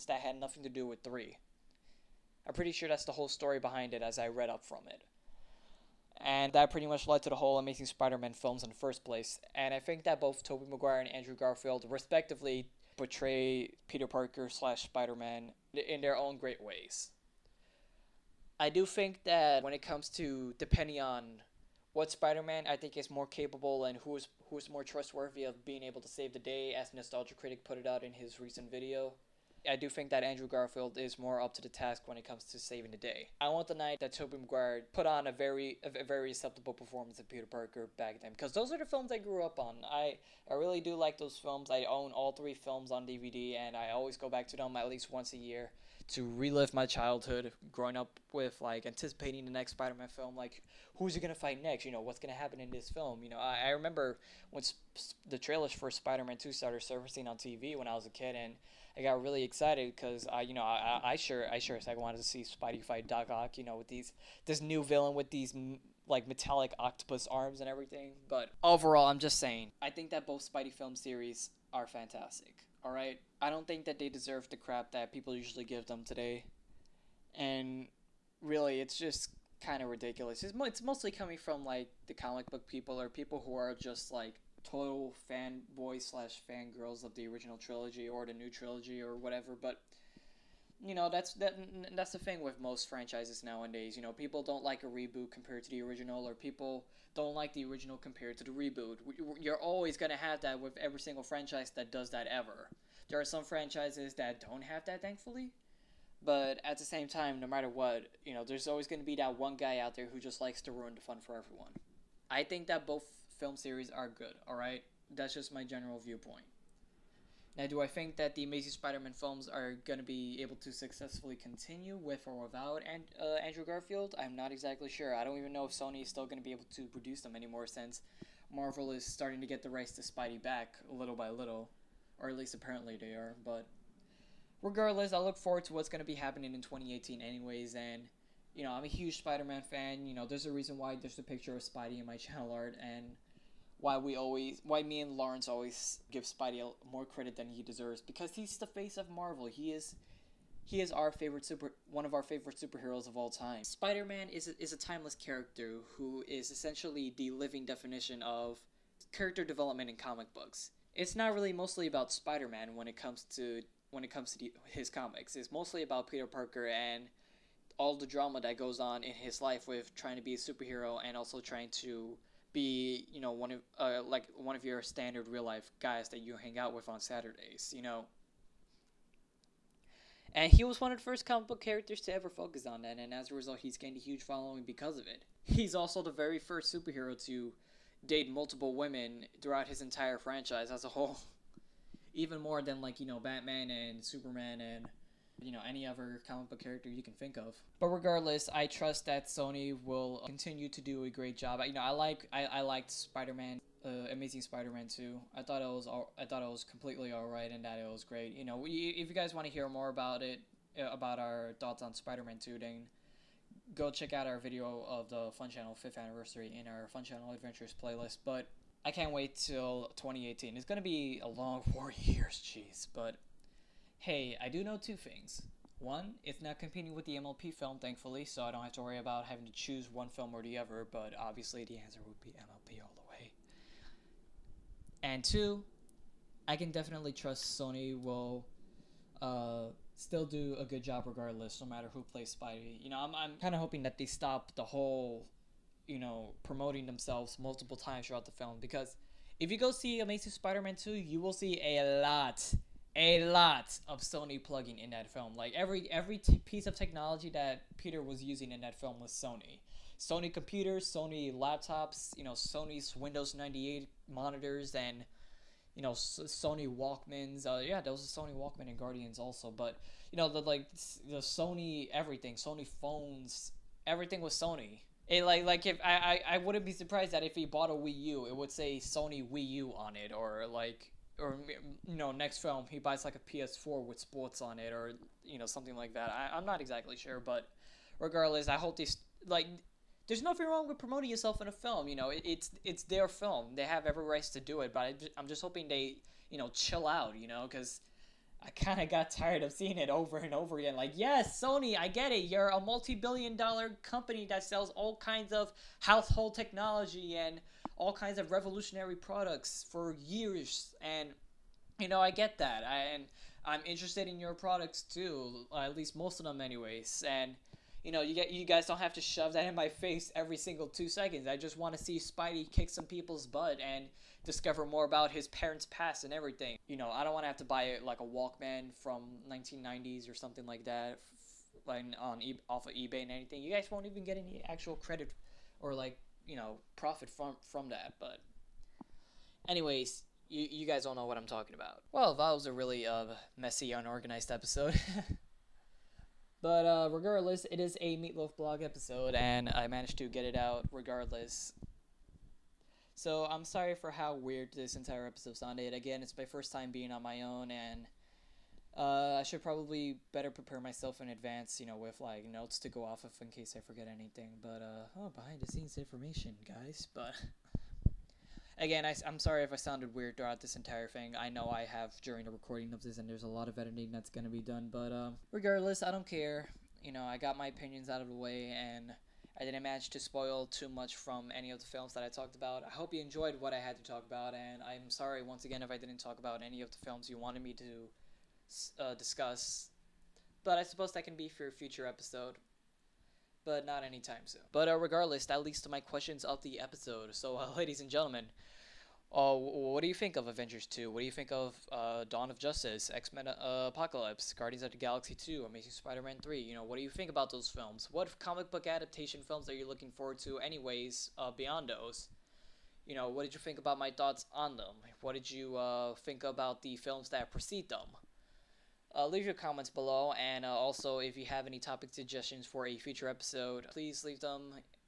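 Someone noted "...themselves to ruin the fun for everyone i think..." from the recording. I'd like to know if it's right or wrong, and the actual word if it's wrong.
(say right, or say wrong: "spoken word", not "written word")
wrong: "likes", not "themselves".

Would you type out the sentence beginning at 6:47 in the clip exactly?
What comic book adaptation films are you looking forward to, anyways, uh, beyond those?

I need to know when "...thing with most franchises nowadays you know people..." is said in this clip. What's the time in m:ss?
1:32.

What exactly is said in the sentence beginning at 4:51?
You know, it, it's it's their film.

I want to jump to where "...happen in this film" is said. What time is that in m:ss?
0:52.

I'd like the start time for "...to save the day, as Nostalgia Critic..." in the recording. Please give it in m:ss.
0:26.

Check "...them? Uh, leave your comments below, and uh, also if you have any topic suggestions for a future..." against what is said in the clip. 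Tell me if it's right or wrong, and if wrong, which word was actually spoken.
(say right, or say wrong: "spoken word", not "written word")
right.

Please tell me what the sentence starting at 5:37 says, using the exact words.
But anyways, you you guys all know what I'm talking about.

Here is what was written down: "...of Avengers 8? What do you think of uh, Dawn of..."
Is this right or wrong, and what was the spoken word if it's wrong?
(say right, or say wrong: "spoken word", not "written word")
wrong: "2", not "8".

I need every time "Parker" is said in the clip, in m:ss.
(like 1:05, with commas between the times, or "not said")
0:14, 0:37, 2:46.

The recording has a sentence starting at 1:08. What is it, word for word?
But overall, I'm just saying, I think that both Spidey film series are fantastic.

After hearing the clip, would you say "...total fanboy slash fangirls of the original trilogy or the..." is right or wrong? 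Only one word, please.
right.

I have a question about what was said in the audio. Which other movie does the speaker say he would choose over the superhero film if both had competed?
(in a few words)
MLP film.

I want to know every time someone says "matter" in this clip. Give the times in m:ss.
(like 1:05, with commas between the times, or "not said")
1:47, 4:01.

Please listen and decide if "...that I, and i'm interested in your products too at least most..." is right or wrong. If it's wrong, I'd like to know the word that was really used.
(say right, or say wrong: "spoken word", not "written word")
right.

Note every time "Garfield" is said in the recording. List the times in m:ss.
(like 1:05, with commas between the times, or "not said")
0:11, 0:30, 2:03.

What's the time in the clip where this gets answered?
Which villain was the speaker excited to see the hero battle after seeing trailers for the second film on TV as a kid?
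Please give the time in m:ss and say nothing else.
1:03.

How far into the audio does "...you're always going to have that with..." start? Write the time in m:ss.
1:39.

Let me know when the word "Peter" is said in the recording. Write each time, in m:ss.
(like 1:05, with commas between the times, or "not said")
0:13, 0:37, 2:46, 4:17.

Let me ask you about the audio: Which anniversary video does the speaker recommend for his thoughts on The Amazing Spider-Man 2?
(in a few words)
5th anniversary.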